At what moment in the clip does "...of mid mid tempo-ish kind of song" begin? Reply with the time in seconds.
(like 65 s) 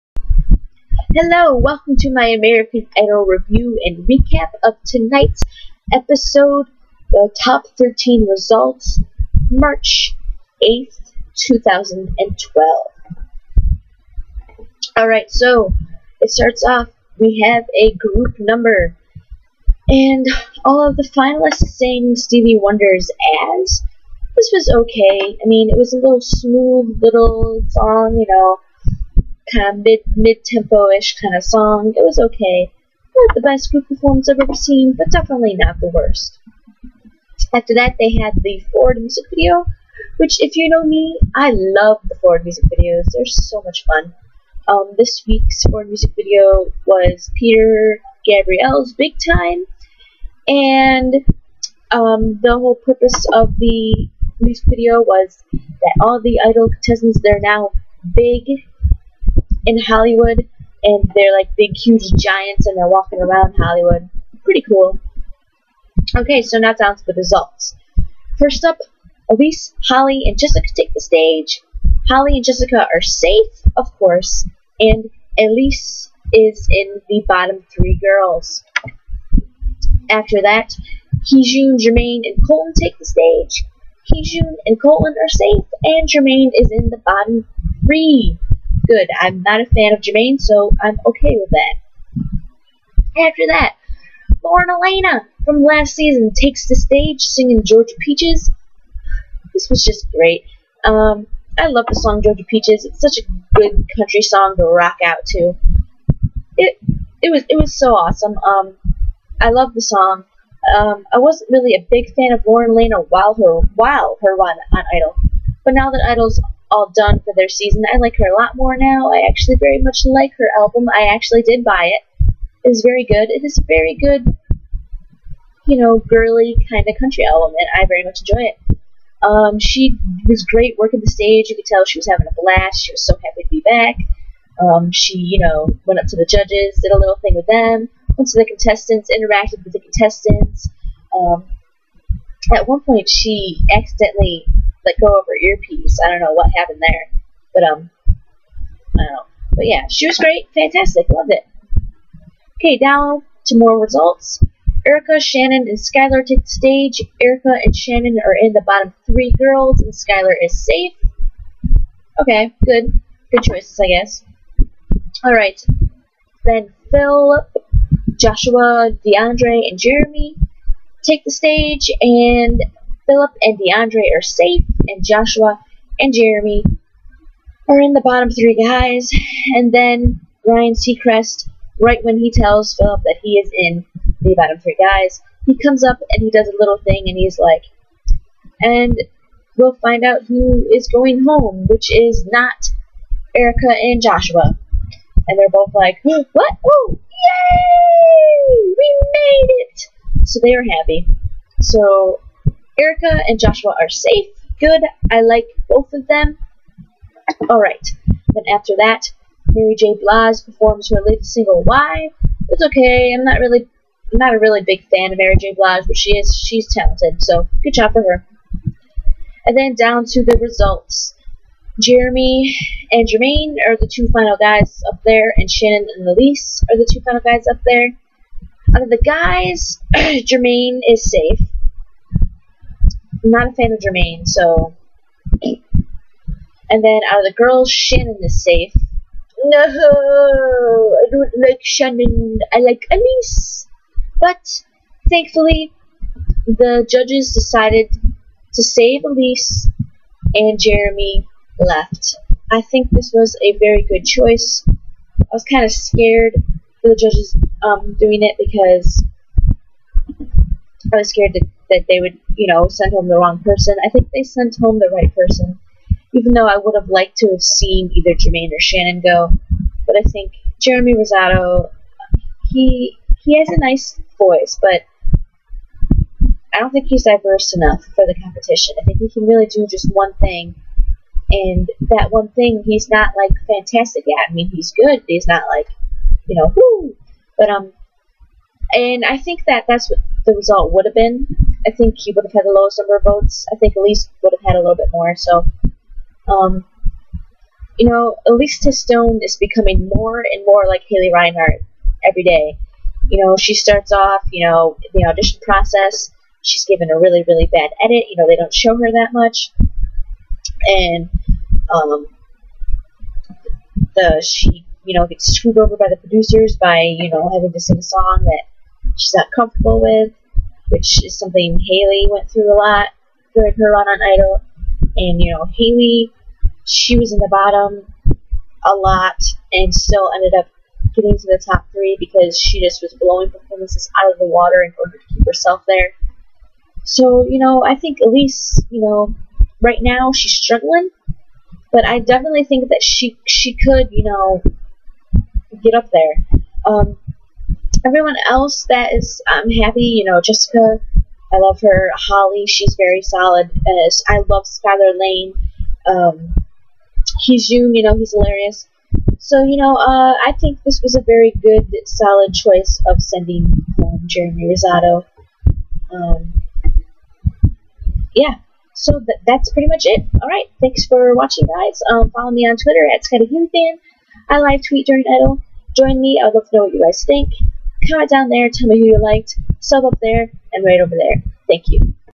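29 s.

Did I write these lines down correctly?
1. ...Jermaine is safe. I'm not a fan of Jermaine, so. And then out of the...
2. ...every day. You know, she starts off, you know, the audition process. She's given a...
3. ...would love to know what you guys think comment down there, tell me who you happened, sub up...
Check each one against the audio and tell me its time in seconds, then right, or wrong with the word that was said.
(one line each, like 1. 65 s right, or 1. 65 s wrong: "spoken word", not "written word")
1. 229 s right
2. 302 s right
3. 376 s wrong: "liked", not "happened".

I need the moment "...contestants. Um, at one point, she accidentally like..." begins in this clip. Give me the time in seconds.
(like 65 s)
139 s.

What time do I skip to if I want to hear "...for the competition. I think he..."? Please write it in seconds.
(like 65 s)
277 s.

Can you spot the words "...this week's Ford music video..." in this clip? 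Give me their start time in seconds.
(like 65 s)
44 s.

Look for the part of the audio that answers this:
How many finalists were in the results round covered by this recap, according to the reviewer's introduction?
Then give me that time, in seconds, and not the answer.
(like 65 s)
7 s.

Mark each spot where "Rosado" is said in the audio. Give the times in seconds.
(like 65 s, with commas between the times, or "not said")
270 s, 364 s.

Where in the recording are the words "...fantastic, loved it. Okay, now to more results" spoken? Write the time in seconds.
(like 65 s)
150 s.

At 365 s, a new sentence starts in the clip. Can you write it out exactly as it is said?
Um, yeah, so th- that's pretty much it.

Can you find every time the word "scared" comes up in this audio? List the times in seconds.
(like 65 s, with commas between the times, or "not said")
255 s, 261 s.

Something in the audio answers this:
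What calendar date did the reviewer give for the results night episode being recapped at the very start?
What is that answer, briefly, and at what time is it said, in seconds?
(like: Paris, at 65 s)
March 8, 2012, at 9 s.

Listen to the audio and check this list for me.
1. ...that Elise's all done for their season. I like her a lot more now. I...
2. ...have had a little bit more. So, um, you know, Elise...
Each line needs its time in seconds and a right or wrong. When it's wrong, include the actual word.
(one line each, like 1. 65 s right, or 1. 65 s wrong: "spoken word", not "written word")
1. 115 s wrong: "Idol", not "Elise"
2. 294 s right.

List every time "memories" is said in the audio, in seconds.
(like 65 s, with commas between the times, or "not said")
not said.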